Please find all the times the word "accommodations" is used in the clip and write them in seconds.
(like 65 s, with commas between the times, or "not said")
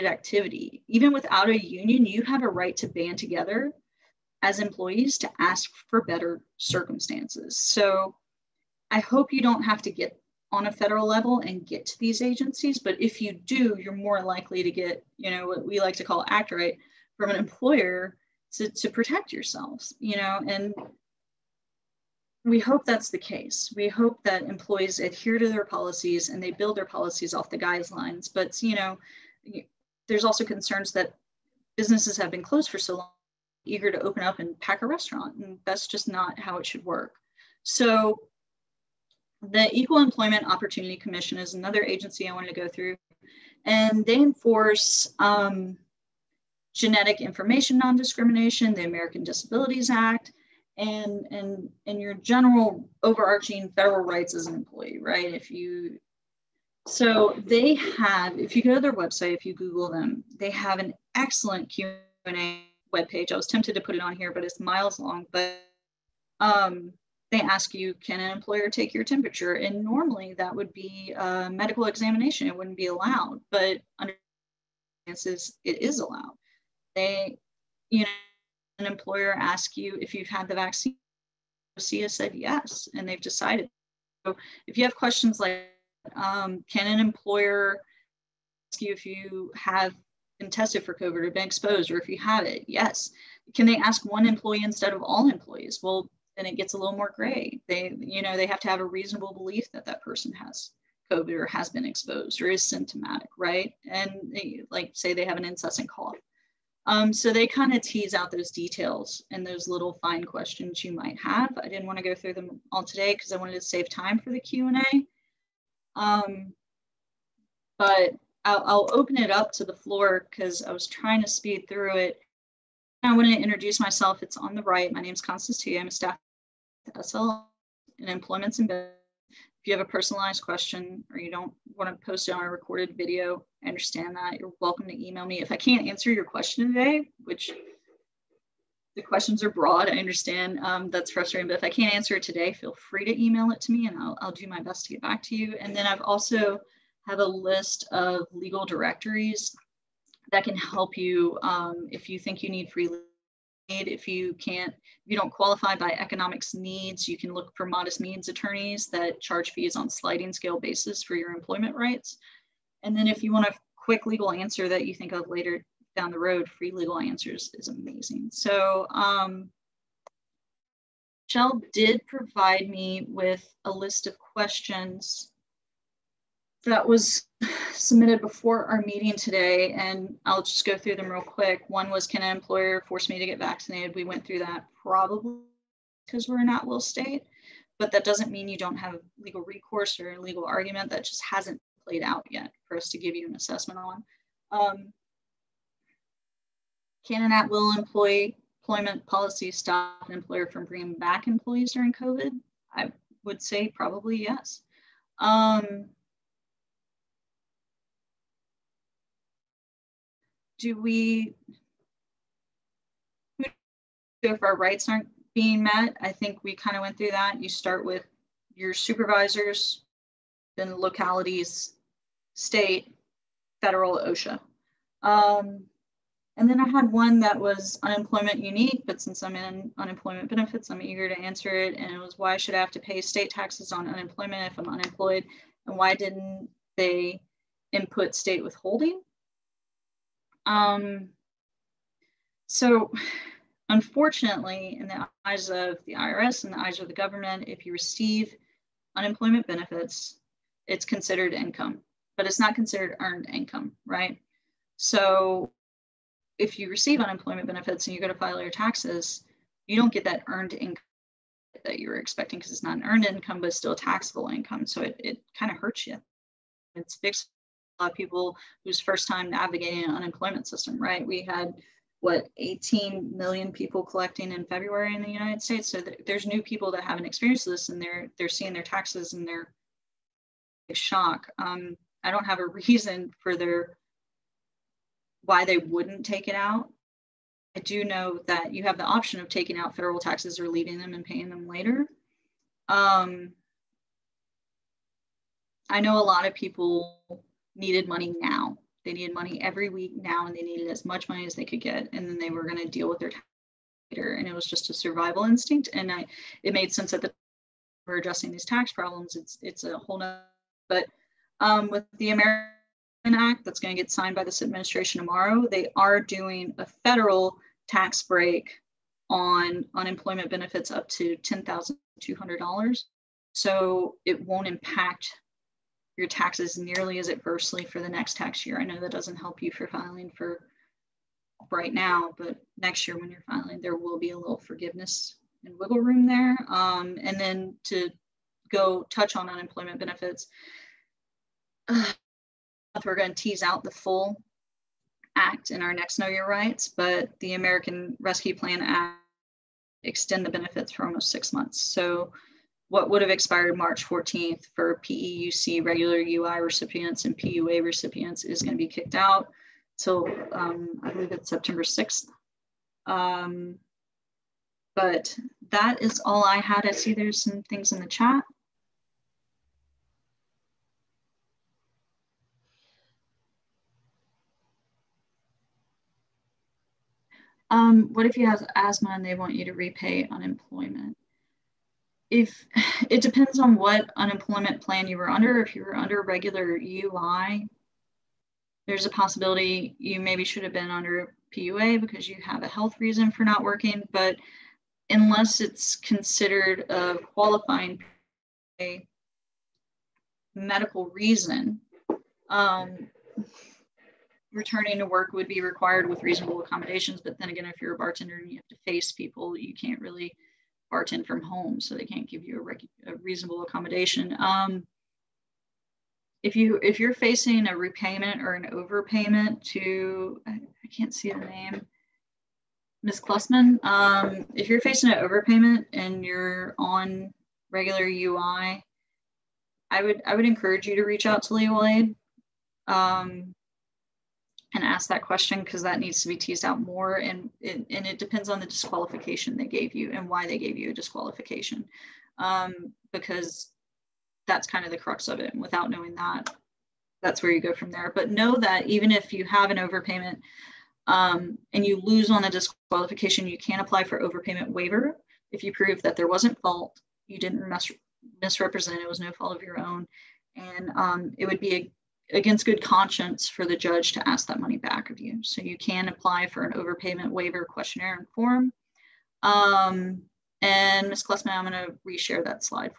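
406 s, 413 s.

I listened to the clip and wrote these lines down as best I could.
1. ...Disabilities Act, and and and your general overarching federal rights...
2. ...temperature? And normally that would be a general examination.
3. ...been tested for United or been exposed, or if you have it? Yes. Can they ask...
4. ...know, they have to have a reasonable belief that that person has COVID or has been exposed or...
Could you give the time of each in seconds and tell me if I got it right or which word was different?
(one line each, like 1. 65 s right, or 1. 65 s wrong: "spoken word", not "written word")
1. 49 s right
2. 69 s wrong: "medical", not "general"
3. 90 s wrong: "COVID", not "United"
4. 98 s right.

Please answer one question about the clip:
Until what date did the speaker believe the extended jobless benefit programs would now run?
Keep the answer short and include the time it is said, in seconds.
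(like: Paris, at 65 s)
September 6th, at 361 s.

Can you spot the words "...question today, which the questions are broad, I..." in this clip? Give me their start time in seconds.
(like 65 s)
136 s.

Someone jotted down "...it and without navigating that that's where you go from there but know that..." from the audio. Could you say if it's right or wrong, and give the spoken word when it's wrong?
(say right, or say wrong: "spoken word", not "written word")
wrong: "knowing", not "navigating".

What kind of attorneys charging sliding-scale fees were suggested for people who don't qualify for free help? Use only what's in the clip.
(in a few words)
modest means attorneys.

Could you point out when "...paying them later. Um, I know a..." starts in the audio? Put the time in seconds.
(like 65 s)
291 s.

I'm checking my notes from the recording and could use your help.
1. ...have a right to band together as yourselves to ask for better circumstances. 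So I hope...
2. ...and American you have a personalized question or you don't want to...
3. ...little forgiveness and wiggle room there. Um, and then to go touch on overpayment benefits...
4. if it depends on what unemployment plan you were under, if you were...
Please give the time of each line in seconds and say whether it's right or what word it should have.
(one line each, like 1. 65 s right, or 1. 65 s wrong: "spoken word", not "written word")
1. 2 s wrong: "employees", not "yourselves"
2. 128 s wrong: "Business", not "American"
3. 334 s wrong: "unemployment", not "overpayment"
4. 382 s right.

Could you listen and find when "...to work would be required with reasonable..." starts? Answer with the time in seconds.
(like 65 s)
404 s.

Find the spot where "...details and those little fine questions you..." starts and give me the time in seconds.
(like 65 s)
108 s.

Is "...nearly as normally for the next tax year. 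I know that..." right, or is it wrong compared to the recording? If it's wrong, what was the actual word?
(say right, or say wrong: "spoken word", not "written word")
wrong: "adversely", not "normally".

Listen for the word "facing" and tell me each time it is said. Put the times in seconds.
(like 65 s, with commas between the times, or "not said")
416 s, 424 s.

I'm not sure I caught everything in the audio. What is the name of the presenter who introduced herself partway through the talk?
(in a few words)
Constance Tui.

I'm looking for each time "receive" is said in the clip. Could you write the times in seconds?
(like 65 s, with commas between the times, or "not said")
247 s, 256 s.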